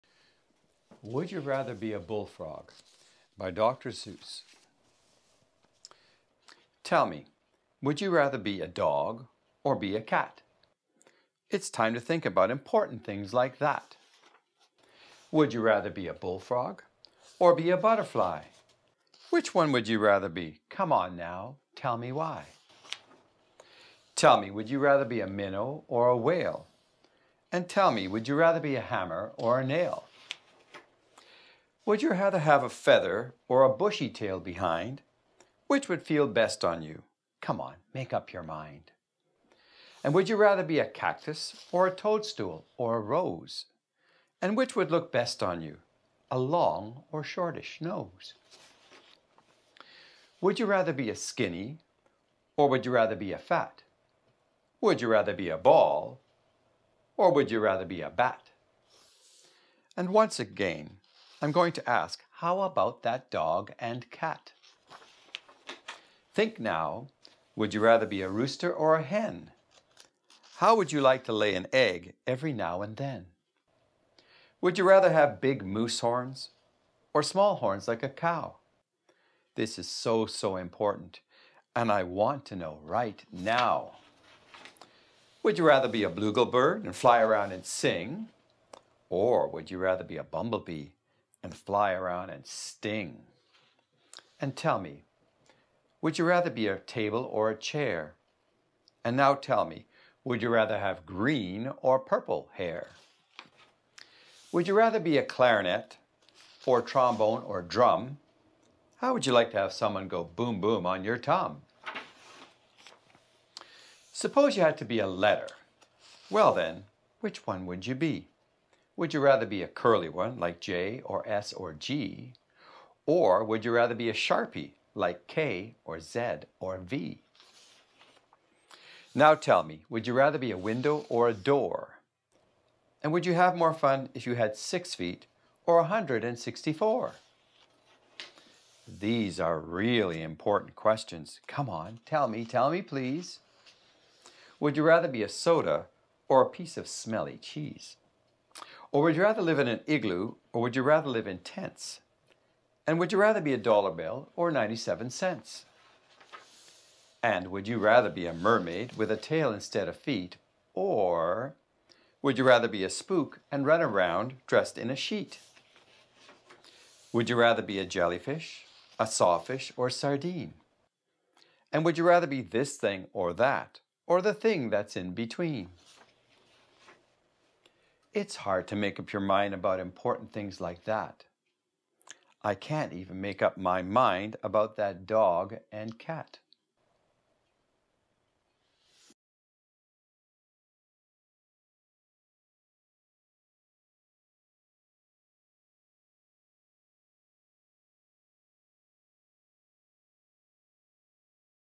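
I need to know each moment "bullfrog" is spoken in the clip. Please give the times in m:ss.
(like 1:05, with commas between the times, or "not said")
0:01, 0:16.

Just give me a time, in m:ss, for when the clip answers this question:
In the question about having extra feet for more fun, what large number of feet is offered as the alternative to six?
2:15.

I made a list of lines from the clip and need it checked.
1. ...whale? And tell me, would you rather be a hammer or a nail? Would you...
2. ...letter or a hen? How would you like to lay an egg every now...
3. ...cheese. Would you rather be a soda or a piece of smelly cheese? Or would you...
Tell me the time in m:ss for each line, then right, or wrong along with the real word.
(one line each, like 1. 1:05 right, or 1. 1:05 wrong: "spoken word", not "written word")
1. 0:26 right
2. 1:08 wrong: "rooster", not "letter"
3. 2:22 wrong: "please", not "cheese".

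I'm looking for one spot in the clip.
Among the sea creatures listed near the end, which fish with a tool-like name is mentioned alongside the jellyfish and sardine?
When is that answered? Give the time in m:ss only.
2:49.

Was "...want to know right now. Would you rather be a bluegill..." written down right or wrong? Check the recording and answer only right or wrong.
right.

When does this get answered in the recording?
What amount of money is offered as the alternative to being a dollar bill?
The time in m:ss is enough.
2:34.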